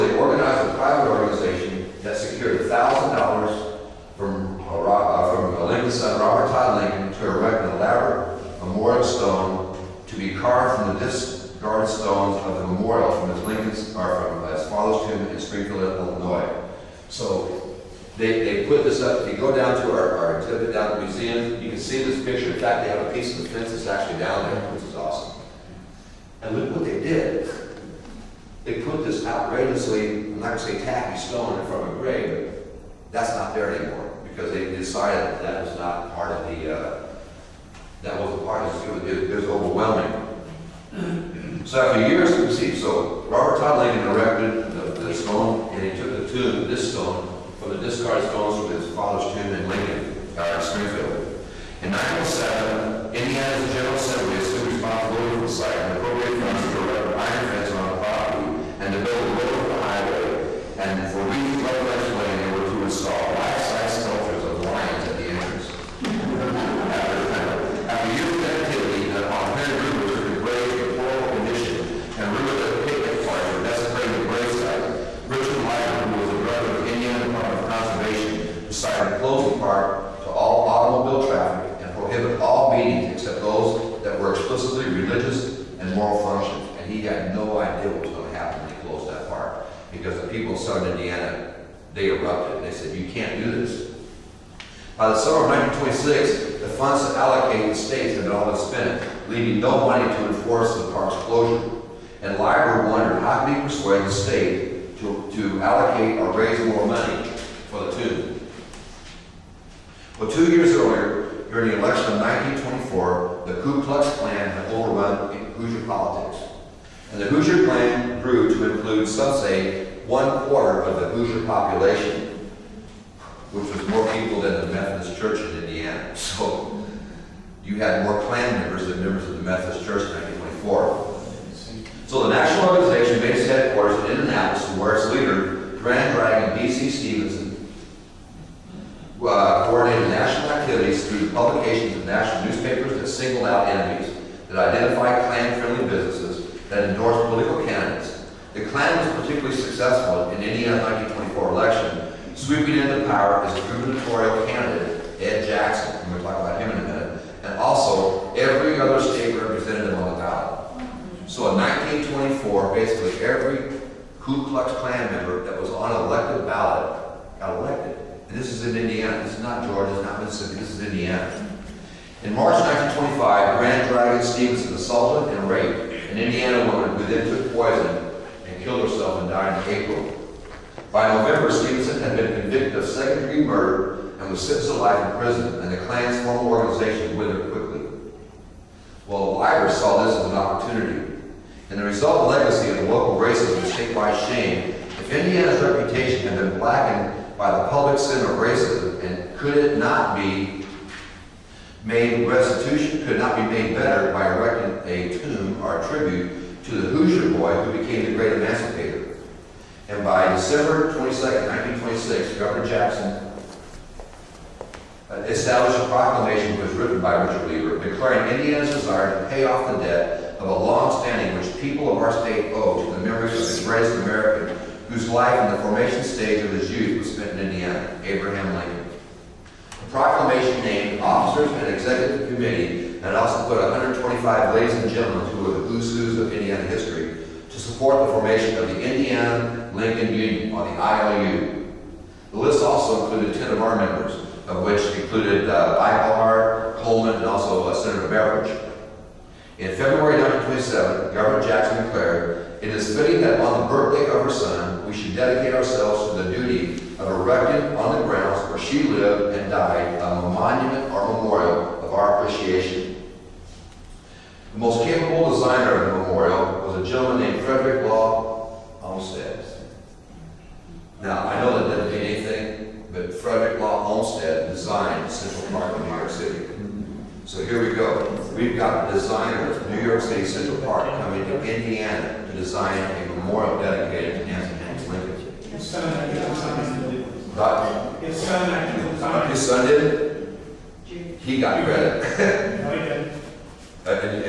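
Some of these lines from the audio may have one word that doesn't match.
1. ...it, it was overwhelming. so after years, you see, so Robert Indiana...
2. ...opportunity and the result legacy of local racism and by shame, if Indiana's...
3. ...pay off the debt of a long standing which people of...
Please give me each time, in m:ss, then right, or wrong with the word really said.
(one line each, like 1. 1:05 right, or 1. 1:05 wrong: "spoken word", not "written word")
1. 0:39 wrong: "Todd", not "Indiana"
2. 3:10 right
3. 3:39 right.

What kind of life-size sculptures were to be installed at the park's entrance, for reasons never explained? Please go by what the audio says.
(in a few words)
Lions.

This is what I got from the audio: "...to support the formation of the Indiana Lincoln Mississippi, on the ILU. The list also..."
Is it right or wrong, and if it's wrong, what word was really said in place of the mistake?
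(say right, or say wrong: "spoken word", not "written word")
wrong: "Union", not "Mississippi".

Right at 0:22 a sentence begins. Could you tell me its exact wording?
In fact, they have a piece of the fence that's actually down there, which is awesome.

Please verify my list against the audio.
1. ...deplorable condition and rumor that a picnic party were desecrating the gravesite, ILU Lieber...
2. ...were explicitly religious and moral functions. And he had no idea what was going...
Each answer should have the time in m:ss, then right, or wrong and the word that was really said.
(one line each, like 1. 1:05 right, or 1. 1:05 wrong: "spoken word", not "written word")
1. 1:10 wrong: "Richard", not "ILU"
2. 1:24 right.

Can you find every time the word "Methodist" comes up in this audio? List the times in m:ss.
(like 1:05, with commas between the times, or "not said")
2:04, 2:09.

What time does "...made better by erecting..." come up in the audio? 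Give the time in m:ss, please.
3:23.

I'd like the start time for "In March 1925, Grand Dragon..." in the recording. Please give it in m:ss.
2:52.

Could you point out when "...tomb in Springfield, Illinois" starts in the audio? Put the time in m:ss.
0:15.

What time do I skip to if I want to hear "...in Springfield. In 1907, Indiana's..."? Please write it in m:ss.
0:50.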